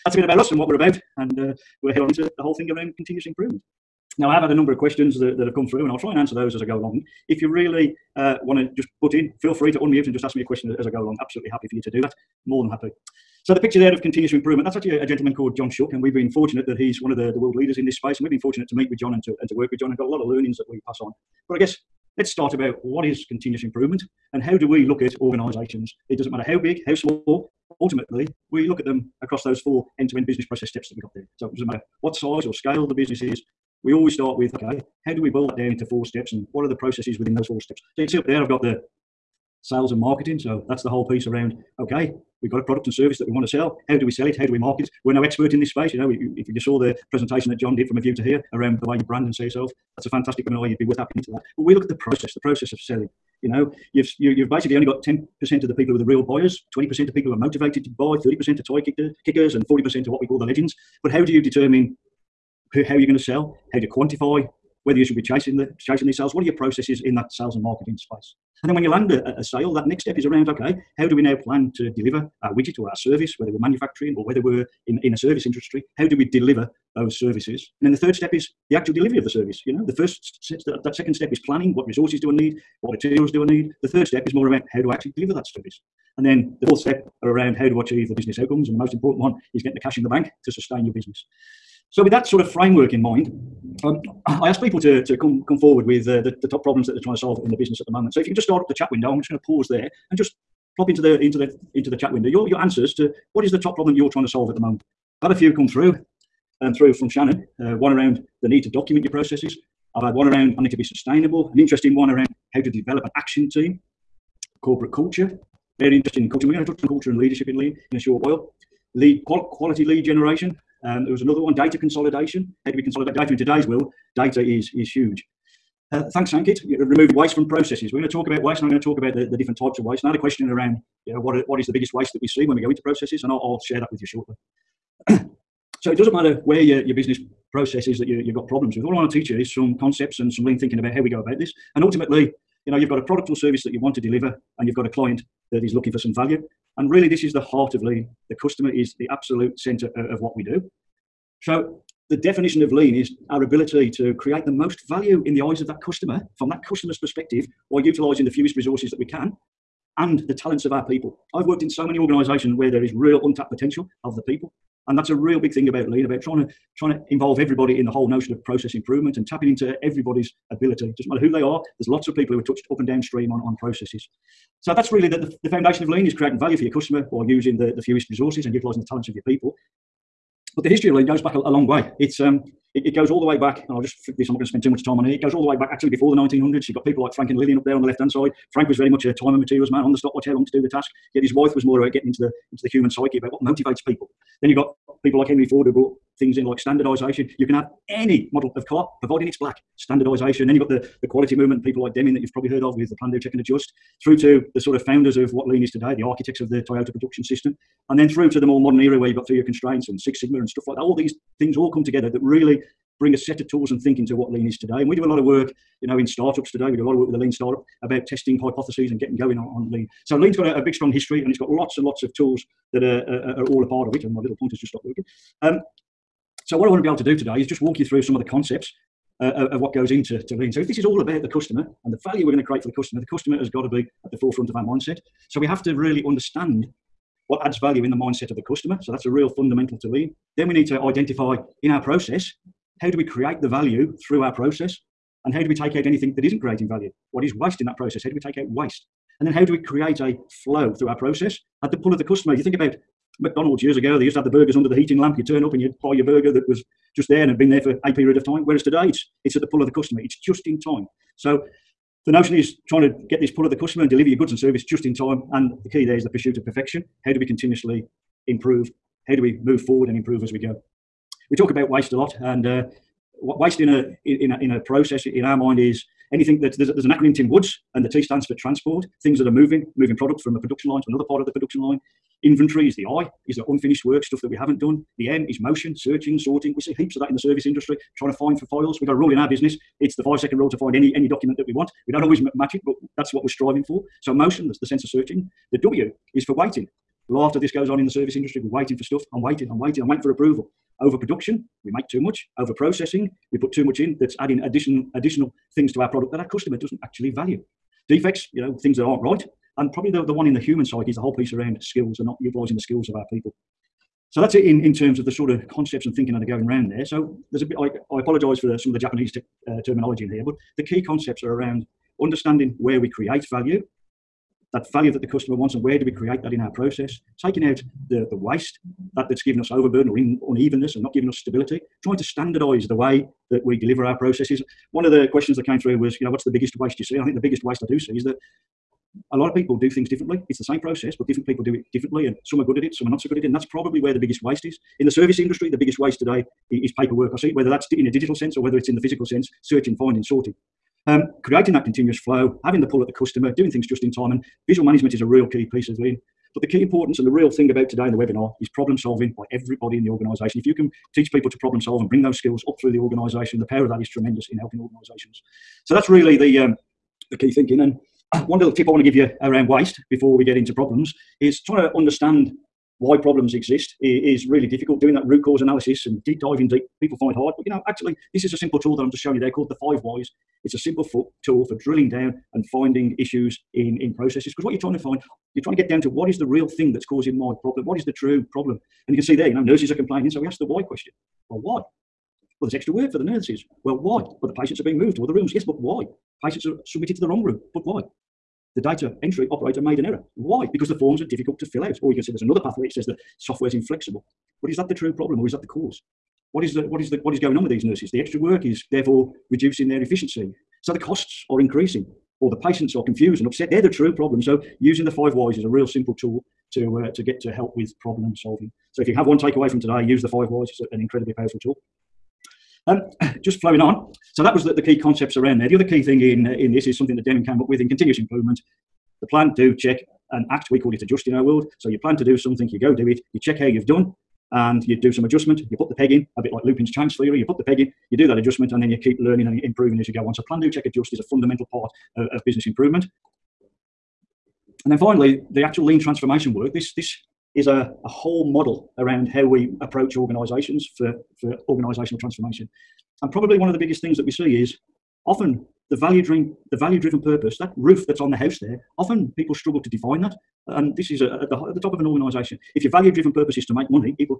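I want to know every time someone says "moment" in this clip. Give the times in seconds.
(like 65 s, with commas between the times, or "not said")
97 s, 104 s.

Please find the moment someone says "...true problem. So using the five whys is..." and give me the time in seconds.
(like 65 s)
413 s.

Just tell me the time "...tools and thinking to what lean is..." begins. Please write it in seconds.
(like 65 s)
213 s.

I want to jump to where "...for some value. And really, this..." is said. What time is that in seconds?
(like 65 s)
145 s.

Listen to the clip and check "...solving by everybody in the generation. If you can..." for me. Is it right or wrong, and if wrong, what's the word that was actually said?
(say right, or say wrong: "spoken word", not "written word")
wrong: "organisation", not "generation".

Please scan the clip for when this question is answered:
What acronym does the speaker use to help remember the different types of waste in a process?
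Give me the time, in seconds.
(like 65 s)
277 s.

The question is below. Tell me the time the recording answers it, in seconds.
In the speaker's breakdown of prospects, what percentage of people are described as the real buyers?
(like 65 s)
55 s.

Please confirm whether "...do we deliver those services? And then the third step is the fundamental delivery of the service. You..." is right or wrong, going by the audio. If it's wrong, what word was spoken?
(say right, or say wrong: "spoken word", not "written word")
wrong: "actual", not "fundamental".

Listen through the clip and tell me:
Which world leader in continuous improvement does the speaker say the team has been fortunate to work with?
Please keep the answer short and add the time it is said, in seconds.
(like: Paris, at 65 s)
John Shook, at 15 s.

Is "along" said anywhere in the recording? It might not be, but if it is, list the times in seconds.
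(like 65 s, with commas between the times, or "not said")
6 s, 10 s.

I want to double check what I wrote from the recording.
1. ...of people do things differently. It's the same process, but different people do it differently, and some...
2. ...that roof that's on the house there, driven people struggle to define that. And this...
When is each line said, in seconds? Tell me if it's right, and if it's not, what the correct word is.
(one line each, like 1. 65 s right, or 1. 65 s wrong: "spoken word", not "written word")
1. 339 s right
2. 457 s wrong: "often", not "driven".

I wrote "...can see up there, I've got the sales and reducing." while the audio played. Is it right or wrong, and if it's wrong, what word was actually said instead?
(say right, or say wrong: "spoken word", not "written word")
wrong: "marketing", not "reducing".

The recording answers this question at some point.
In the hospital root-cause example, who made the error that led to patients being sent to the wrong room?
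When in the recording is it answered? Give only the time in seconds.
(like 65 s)
398 s.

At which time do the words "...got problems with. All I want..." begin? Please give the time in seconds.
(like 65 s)
138 s.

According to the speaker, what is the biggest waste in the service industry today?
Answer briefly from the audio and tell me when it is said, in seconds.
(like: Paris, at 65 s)
paperwork, at 346 s.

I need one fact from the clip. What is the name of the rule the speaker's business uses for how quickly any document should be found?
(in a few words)
five second rule.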